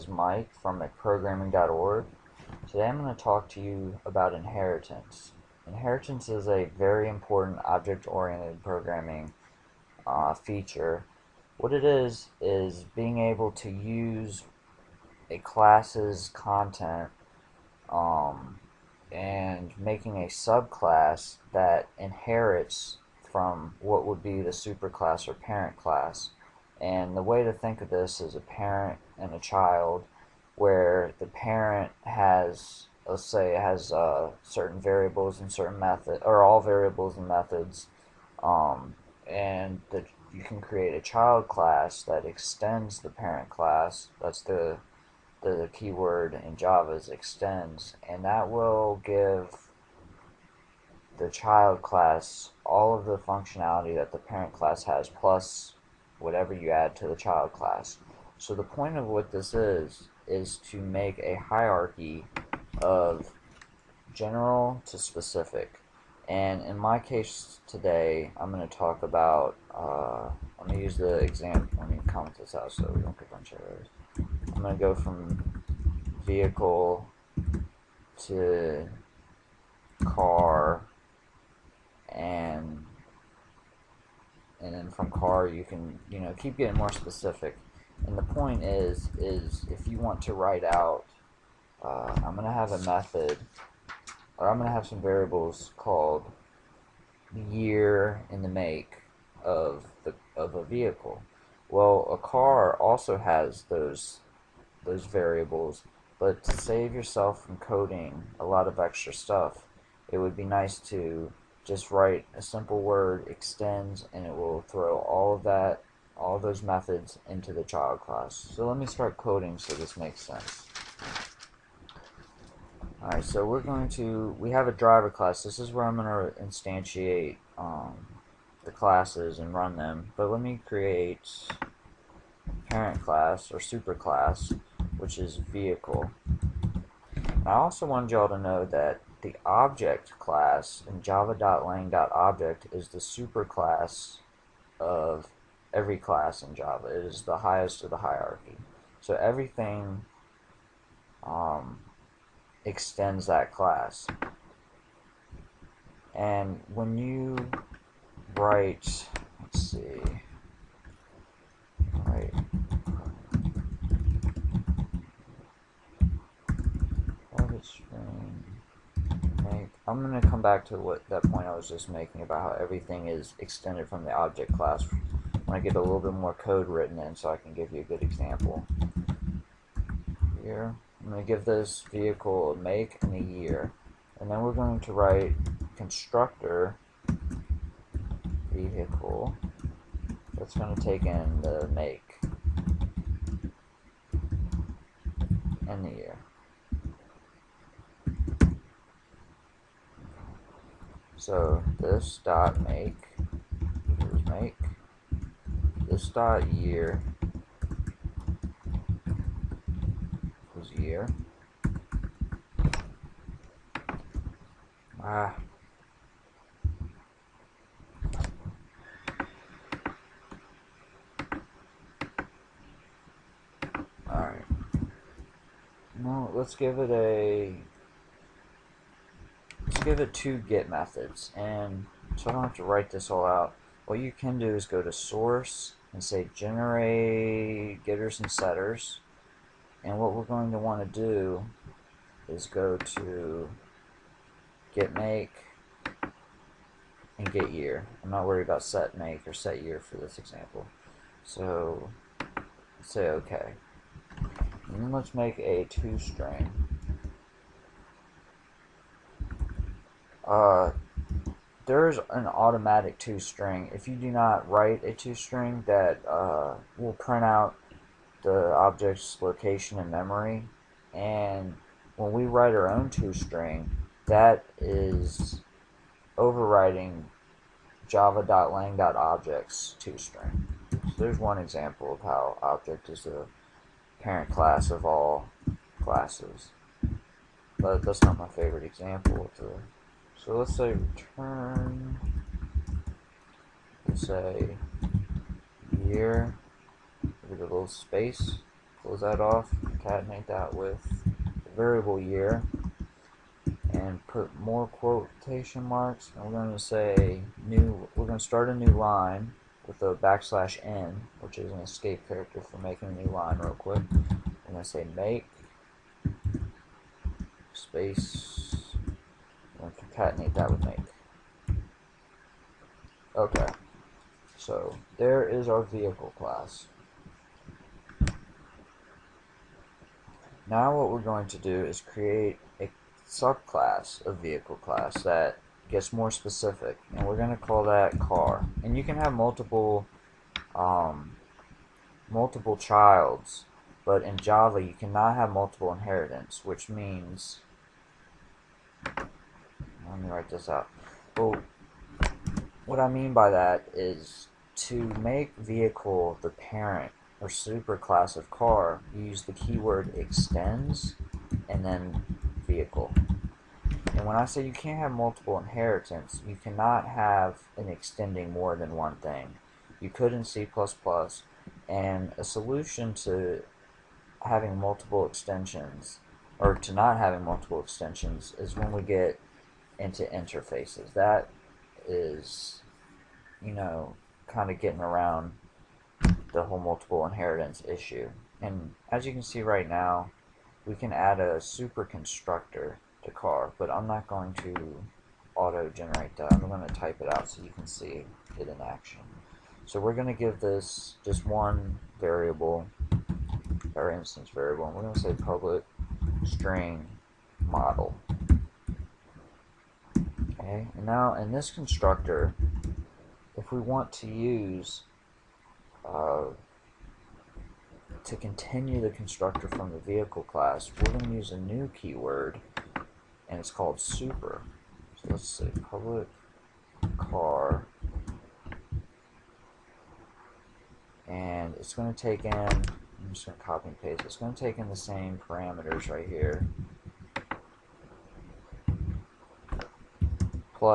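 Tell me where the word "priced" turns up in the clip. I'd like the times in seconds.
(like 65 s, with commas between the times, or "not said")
not said.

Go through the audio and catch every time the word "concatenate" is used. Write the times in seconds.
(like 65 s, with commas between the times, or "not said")
299 s, 319 s.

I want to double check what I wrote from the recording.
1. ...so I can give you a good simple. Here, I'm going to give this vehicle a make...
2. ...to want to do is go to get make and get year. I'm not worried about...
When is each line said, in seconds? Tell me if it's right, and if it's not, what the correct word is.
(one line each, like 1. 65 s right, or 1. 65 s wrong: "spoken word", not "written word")
1. 177 s wrong: "example", not "simple"
2. 240 s right.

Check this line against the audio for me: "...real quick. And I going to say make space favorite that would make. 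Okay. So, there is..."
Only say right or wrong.
wrong.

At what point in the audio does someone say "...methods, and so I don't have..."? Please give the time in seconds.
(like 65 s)
230 s.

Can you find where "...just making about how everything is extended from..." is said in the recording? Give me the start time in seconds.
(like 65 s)
171 s.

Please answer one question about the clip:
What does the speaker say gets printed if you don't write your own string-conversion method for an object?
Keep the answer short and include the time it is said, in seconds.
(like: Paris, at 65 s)
location in memory, at 268 s.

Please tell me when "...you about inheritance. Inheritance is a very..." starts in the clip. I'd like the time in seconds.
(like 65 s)
3 s.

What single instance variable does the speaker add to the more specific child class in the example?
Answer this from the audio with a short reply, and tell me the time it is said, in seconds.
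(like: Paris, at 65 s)
model, at 405 s.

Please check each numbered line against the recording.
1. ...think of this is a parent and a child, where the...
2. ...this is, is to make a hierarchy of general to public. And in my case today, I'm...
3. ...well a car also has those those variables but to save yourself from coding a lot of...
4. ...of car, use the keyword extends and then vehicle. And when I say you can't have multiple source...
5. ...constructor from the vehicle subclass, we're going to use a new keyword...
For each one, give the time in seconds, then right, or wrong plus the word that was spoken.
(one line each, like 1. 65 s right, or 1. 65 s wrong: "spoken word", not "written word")
1. 27 s right
2. 59 s wrong: "specific", not "public"
3. 101 s right
4. 358 s wrong: "inheritance", not "source"
5. 418 s wrong: "class", not "subclass".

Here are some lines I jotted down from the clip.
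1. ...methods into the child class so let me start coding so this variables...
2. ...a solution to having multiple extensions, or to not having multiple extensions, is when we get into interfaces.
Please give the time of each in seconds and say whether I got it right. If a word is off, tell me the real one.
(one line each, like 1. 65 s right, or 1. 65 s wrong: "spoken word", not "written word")
1. 116 s wrong: "makes", not "variables"
2. 372 s right.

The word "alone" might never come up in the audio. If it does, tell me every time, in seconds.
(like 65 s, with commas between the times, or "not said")
not said.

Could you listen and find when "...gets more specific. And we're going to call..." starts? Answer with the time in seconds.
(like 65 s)
335 s.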